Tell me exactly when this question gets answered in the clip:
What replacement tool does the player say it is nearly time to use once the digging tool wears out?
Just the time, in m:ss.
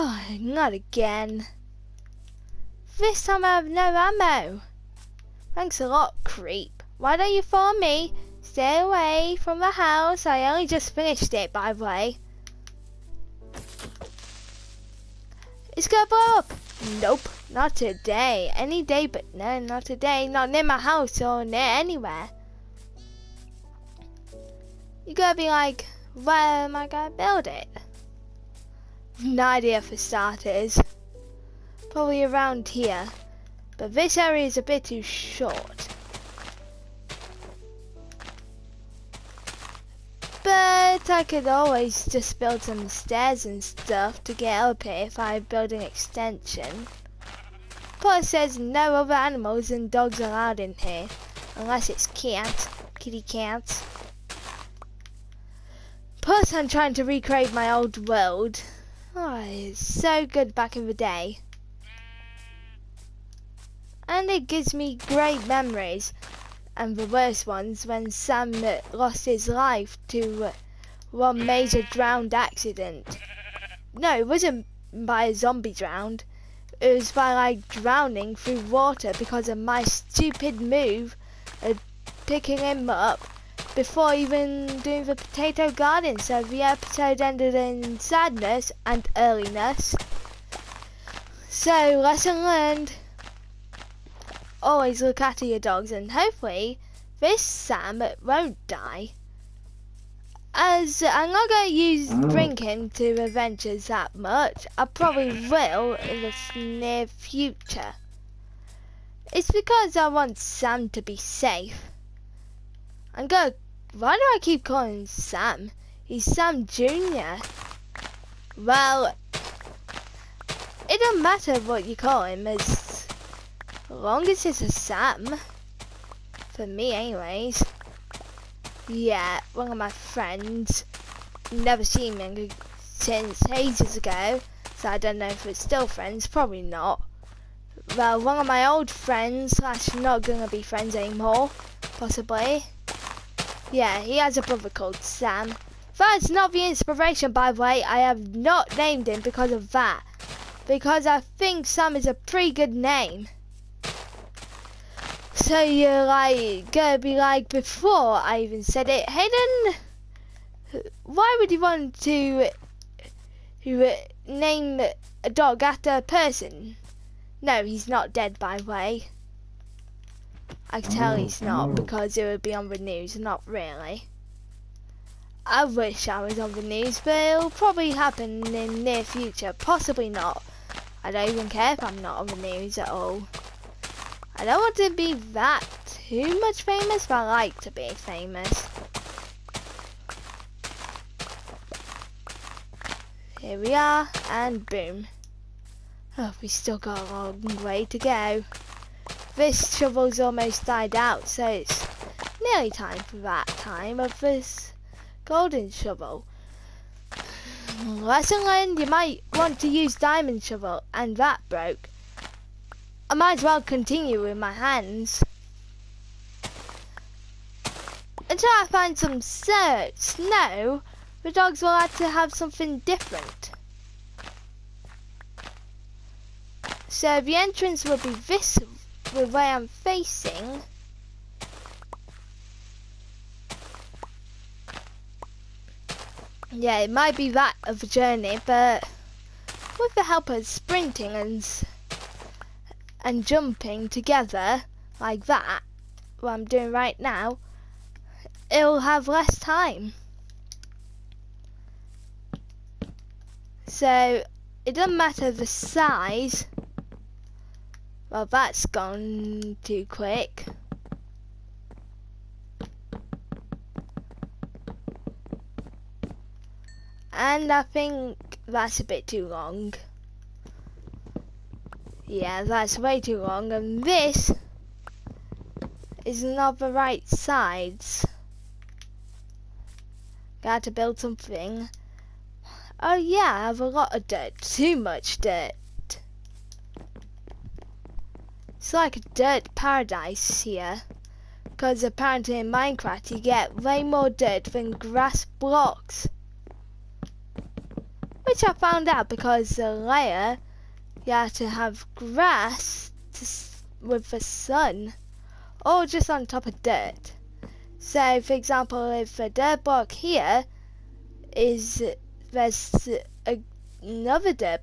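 3:25.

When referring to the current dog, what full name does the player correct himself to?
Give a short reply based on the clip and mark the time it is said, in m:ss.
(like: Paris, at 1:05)
Sam Jr., at 1:56.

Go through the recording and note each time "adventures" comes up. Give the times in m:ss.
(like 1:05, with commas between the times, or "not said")
1:43.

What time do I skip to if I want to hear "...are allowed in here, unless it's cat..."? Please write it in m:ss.
0:50.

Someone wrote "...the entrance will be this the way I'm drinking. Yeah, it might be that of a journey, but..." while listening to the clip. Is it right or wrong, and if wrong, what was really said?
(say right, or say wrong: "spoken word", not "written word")
wrong: "facing", not "drinking".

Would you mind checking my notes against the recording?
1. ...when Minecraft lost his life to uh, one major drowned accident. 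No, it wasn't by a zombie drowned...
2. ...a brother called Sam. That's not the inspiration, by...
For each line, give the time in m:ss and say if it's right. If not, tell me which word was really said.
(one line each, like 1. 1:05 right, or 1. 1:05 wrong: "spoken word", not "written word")
1. 1:07 wrong: "Sam", not "Minecraft"
2. 2:24 right.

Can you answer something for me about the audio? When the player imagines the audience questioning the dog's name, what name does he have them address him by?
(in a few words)
Hayden.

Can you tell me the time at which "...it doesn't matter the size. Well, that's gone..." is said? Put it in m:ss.
4:14.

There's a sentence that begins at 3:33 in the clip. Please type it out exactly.
I might as well continue with my hands.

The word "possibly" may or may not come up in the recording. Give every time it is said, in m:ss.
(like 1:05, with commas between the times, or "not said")
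2:21, 2:59.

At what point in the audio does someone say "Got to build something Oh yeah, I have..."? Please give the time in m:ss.
4:40.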